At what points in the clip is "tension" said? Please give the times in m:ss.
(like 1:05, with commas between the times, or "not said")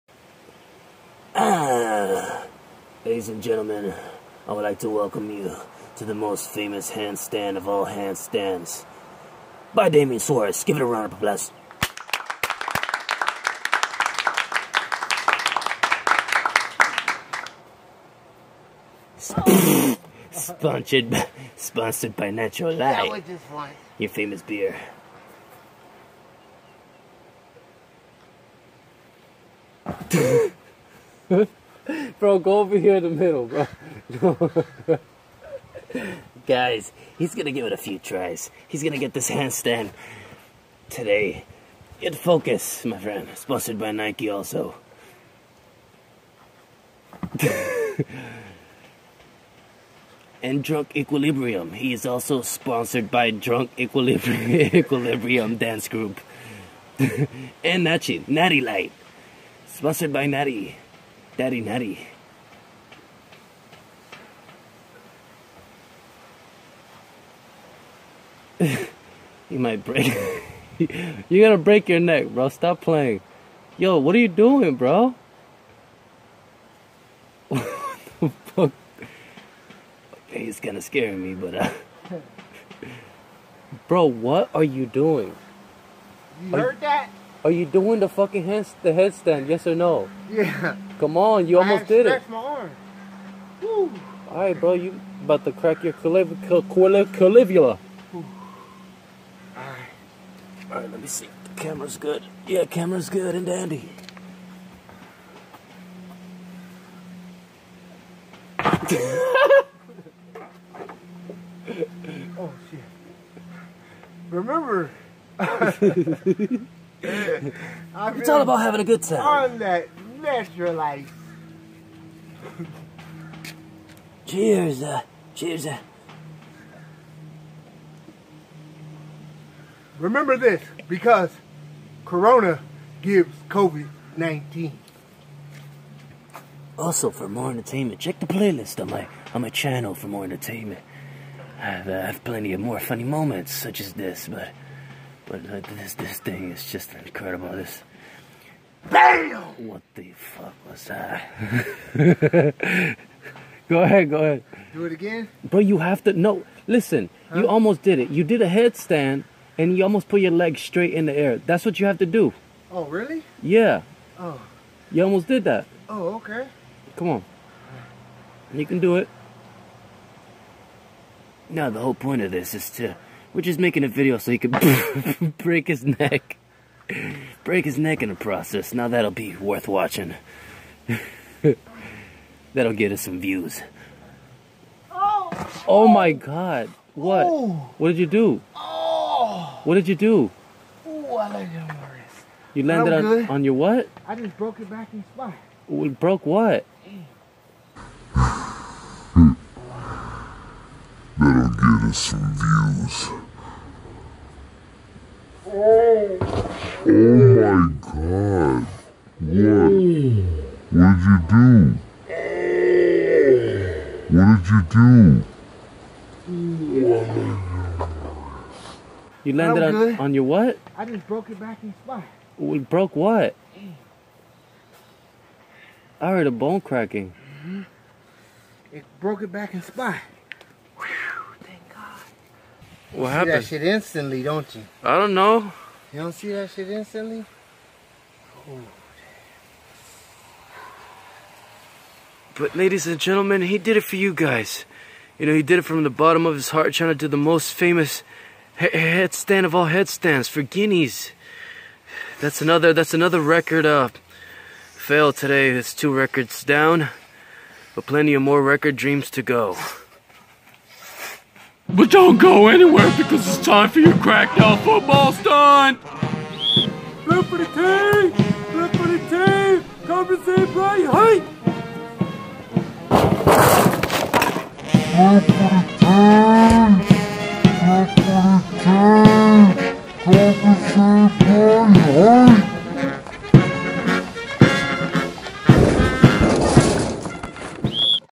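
not said.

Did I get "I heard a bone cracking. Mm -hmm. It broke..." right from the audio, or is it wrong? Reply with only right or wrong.
right.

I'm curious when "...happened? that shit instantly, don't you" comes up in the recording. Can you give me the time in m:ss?
3:53.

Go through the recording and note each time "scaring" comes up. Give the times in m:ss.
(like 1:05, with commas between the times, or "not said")
1:20.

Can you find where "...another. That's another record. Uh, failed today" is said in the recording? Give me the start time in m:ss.
4:12.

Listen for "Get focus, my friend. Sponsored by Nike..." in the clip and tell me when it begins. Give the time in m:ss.
0:41.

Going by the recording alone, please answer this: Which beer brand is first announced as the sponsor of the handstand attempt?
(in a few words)
Natural Light.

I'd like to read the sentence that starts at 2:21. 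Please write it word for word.
I've, uh, I've plenty of more funny moments such as this, but but uh, this this thing is just incredible.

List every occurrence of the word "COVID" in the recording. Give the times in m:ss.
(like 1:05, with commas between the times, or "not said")
2:13.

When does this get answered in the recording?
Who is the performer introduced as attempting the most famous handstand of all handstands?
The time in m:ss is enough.
0:09.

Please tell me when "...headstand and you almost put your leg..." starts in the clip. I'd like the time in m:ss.
2:38.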